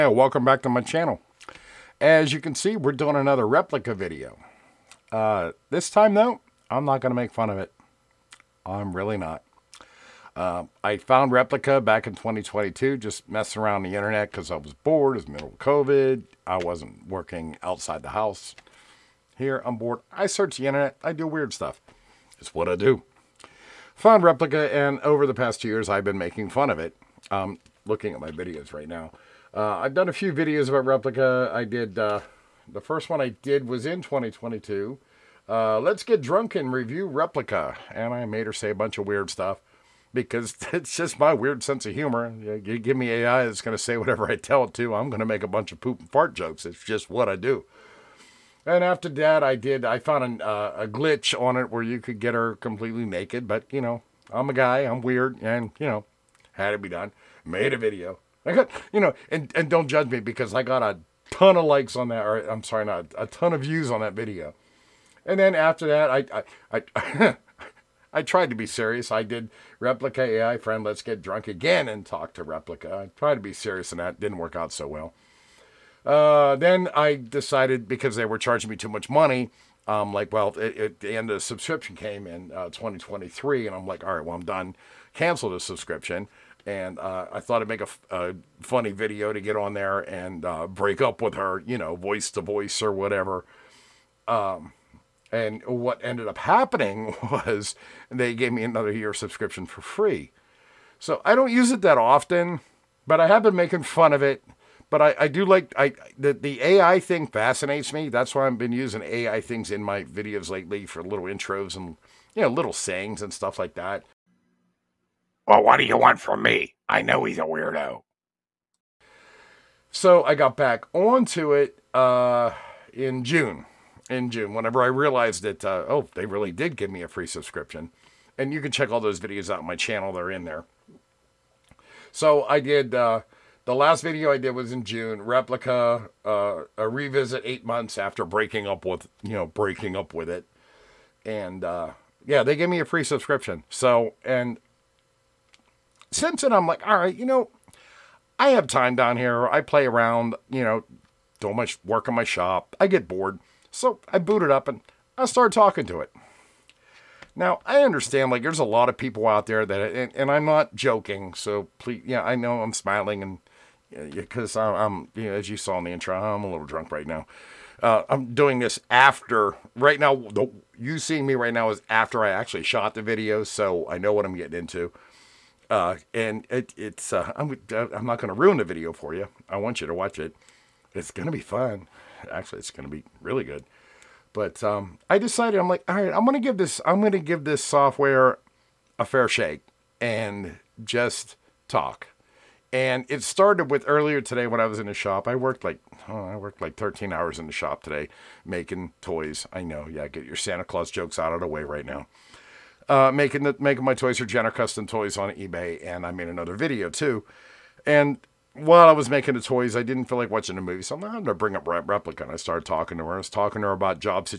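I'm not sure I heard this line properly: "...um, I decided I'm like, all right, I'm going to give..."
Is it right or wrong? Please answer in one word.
right.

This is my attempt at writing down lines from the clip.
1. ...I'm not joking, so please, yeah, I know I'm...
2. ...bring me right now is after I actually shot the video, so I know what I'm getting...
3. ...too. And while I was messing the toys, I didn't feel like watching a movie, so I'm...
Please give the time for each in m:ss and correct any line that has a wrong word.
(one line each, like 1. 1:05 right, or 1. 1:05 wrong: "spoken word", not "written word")
1. 2:40 right
2. 2:50 wrong: "seeing", not "bring"
3. 3:26 wrong: "making", not "messing".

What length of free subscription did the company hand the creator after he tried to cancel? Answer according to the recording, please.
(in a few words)
1 year.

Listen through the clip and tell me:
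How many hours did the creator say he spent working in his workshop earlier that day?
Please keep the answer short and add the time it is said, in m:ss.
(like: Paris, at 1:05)
13, at 3:16.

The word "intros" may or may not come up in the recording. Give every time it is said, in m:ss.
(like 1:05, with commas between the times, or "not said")
1:51, 2:45.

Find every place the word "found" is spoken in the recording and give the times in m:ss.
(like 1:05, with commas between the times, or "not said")
0:10, 0:23, 0:49.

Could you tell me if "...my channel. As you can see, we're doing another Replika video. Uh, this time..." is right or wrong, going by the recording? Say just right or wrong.
right.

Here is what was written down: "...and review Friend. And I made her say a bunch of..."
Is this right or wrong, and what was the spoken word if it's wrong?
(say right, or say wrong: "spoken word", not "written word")
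wrong: "Replika", not "Friend".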